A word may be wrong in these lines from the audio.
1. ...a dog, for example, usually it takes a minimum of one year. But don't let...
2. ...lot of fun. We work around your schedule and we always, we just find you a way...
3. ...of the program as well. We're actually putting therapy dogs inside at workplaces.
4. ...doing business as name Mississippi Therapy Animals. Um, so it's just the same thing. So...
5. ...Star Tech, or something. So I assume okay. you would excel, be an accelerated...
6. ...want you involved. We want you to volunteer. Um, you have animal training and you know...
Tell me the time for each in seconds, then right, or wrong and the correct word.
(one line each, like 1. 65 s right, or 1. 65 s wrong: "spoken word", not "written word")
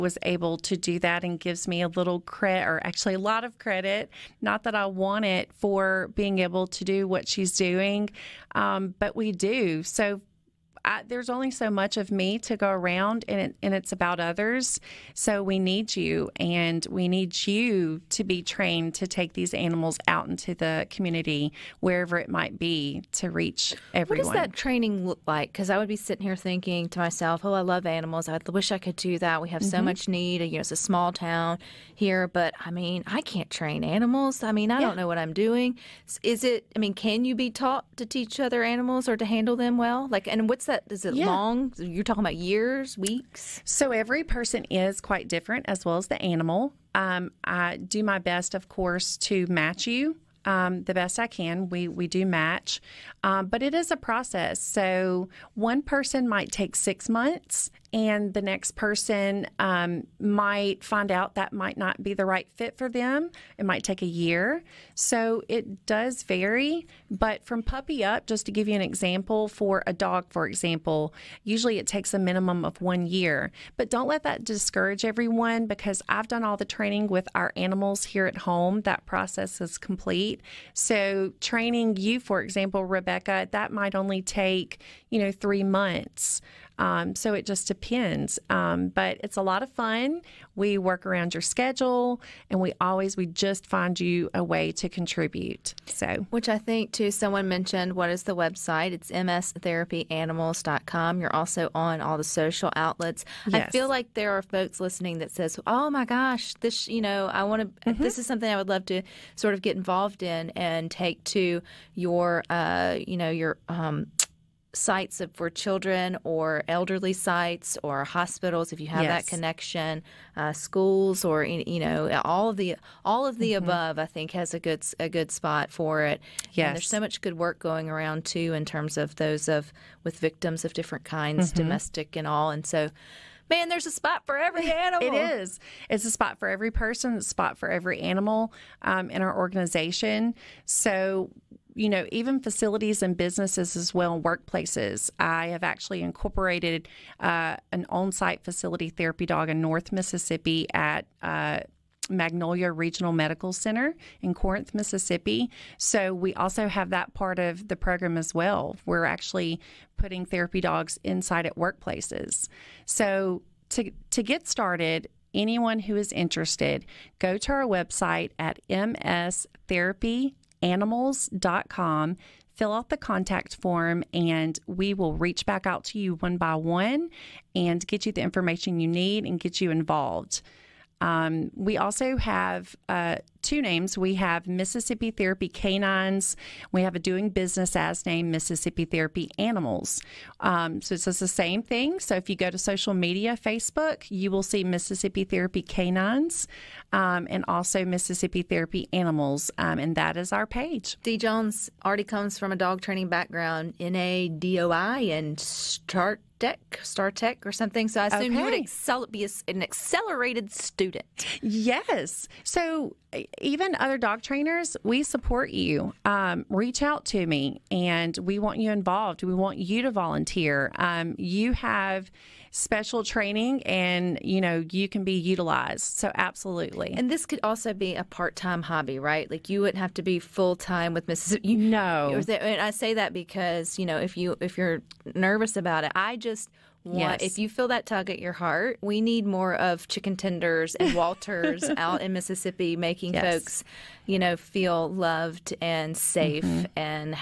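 1. 69 s right
2. 89 s right
3. 157 s right
4. 186 s right
5. 206 s right
6. 218 s wrong: "special", not "animal".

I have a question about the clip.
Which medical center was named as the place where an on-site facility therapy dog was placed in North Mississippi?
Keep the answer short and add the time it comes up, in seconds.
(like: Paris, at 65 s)
Magnolia Regional Medical Center, at 152 s.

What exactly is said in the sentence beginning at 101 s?
You're also on all the social outlets.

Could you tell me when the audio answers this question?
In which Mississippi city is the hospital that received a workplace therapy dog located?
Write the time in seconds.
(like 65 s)
154 s.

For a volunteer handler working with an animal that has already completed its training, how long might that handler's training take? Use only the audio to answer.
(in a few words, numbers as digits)
3 months.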